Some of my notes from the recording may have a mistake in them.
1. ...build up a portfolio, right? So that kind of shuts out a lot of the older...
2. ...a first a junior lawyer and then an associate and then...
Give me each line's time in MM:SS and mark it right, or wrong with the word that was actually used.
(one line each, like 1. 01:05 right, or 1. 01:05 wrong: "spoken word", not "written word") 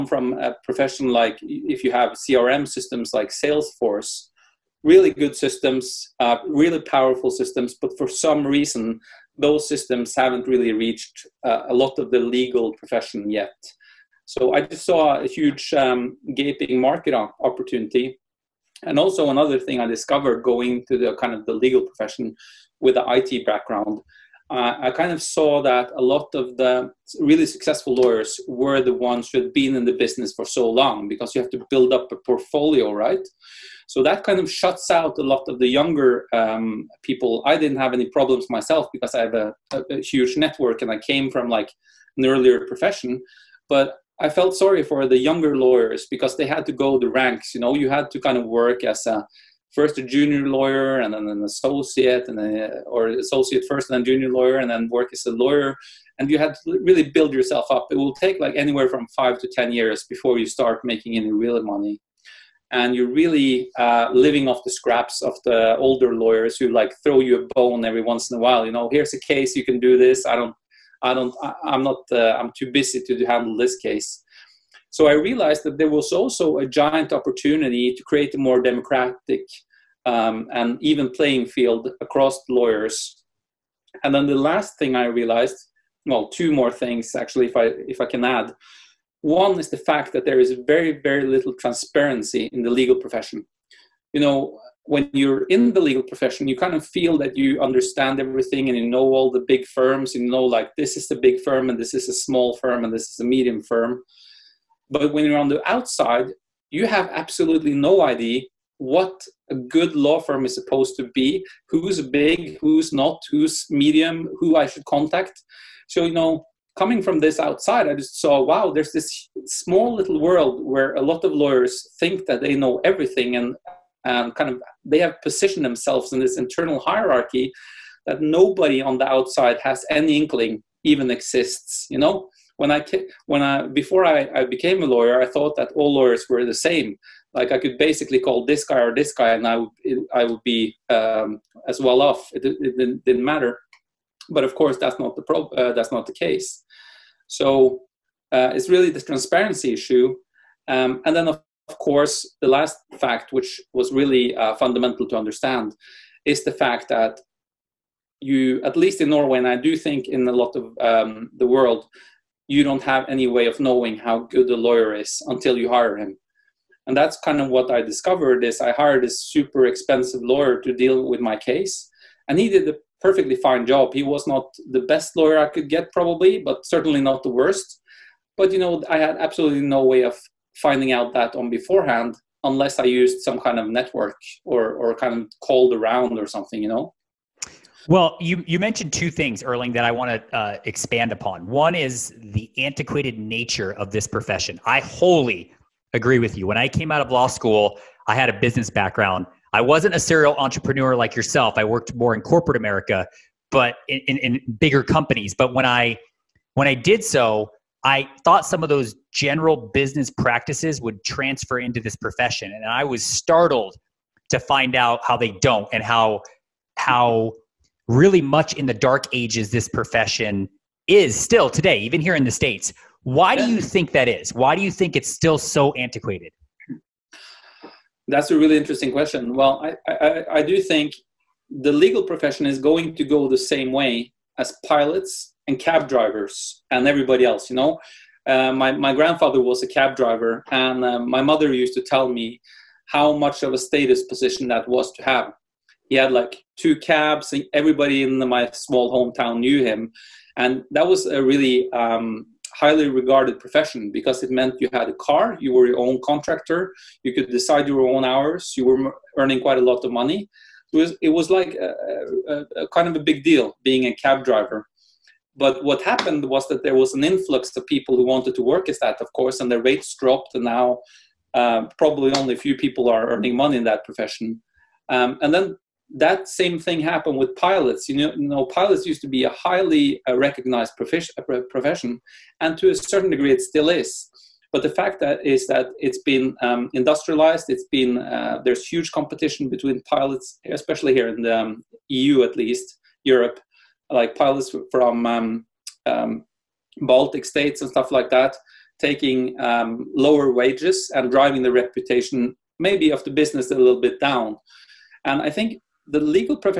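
1. 00:31 wrong: "younger", not "older"
2. 00:49 right.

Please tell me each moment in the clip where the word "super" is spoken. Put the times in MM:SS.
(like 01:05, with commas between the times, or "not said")
02:49.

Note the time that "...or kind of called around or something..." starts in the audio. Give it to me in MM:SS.
03:04.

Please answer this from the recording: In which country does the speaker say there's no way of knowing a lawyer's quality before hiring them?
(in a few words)
Norway.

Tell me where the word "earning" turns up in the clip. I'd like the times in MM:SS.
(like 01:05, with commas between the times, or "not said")
04:19, 04:33.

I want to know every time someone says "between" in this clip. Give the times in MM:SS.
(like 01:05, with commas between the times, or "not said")
04:49.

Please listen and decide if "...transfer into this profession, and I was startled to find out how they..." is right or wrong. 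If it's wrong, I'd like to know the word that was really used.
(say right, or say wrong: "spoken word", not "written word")
right.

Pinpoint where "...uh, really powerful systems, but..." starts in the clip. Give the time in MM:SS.
00:06.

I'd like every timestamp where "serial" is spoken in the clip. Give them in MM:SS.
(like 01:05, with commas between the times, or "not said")
03:19.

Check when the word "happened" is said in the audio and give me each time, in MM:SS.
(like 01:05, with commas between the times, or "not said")
04:25, 04:36.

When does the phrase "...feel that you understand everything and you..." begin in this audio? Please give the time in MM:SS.
01:36.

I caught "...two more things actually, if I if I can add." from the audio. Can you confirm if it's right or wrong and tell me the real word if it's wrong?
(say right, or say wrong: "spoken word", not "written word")
right.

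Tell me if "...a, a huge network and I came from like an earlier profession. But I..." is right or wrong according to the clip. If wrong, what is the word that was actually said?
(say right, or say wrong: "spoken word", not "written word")
right.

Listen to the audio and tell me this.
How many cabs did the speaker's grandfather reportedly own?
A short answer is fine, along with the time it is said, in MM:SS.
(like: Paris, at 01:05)
2, at 04:06.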